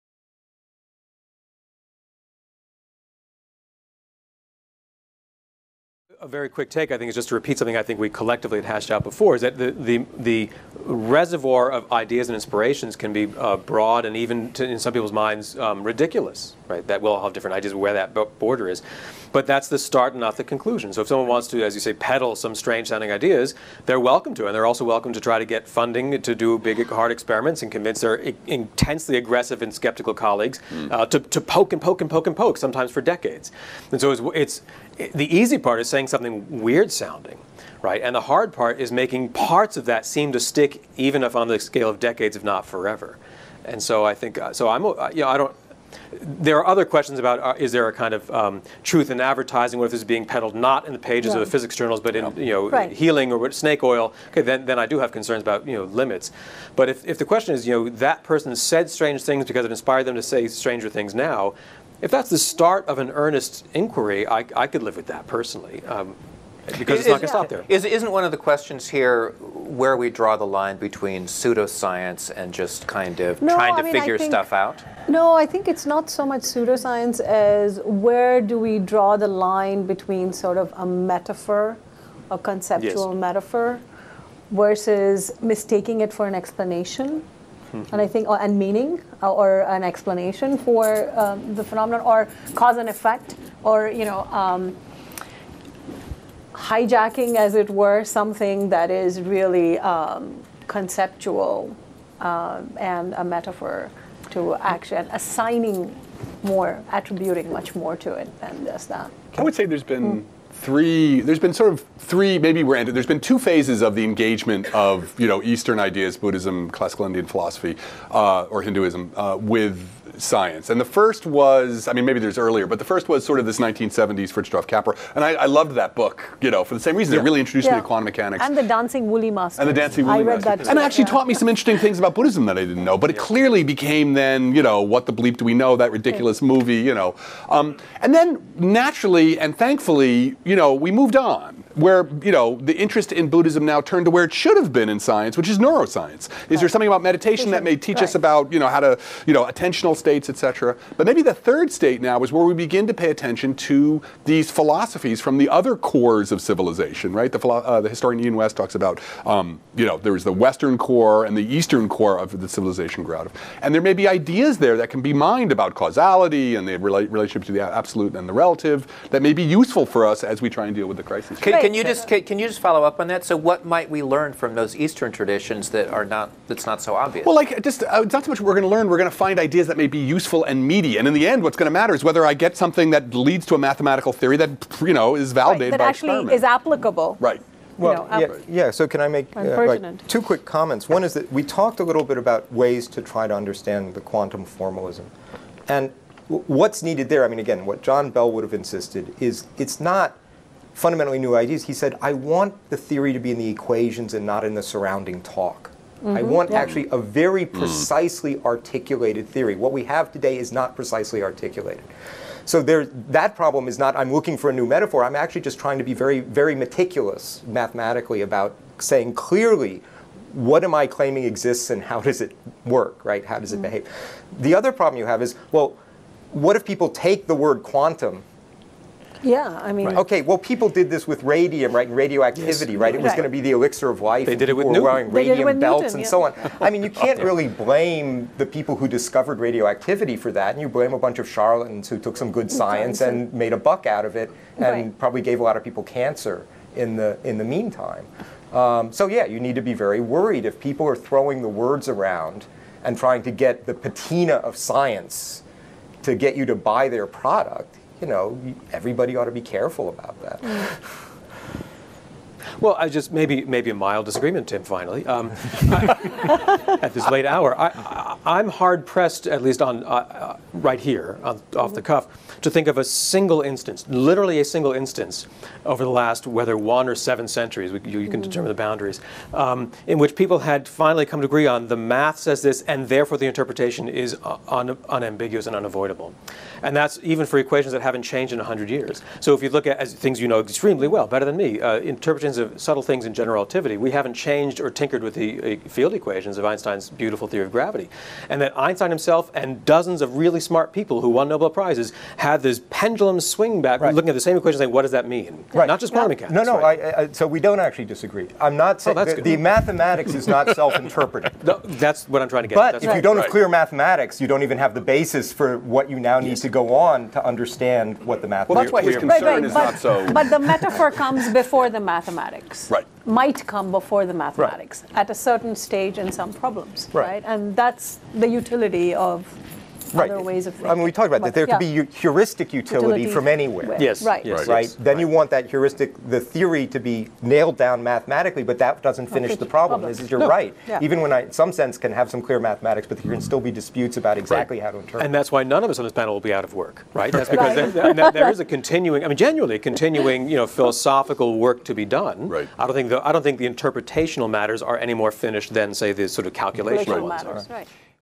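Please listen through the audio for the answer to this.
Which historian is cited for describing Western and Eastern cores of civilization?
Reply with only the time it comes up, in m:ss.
2:38.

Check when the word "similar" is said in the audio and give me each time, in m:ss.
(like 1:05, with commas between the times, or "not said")
not said.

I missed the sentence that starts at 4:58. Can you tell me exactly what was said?
And that Einstein himself and dozens of really smart people who won Nobel Prizes had this pendulum swing back, right.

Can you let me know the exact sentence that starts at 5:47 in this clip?
There, there, there is a continuing, I mean, genuinely continuing, you know, philosophical work to be done.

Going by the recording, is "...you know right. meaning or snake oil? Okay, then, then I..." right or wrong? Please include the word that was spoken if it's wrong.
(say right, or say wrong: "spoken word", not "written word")
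wrong: "healing", not "meaning".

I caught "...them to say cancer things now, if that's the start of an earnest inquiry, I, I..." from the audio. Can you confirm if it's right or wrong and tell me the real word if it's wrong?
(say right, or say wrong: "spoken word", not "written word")
wrong: "stranger", not "cancer".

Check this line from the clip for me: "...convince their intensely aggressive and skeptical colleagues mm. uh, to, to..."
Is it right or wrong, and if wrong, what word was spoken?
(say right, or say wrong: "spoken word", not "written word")
right.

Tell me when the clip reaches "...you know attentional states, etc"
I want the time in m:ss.
2:29.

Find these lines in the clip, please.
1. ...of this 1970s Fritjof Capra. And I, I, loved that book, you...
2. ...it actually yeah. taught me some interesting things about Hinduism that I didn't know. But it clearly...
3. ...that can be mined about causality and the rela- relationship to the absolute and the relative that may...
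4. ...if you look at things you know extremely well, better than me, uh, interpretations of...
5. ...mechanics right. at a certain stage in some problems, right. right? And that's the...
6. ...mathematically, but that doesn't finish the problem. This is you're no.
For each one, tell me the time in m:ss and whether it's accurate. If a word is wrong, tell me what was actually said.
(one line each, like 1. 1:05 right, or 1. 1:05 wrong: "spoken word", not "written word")
1. 2:03 right
2. 2:10 wrong: "Buddhism", not "Hinduism"
3. 2:44 right
4. 4:49 right
5. 5:24 wrong: "mathematics", not "mechanics"
6. 5:37 right.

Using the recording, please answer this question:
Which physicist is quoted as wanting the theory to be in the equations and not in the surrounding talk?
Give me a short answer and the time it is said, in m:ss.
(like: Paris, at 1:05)
John Bell, at 3:17.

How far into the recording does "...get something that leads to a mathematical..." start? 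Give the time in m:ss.
3:02.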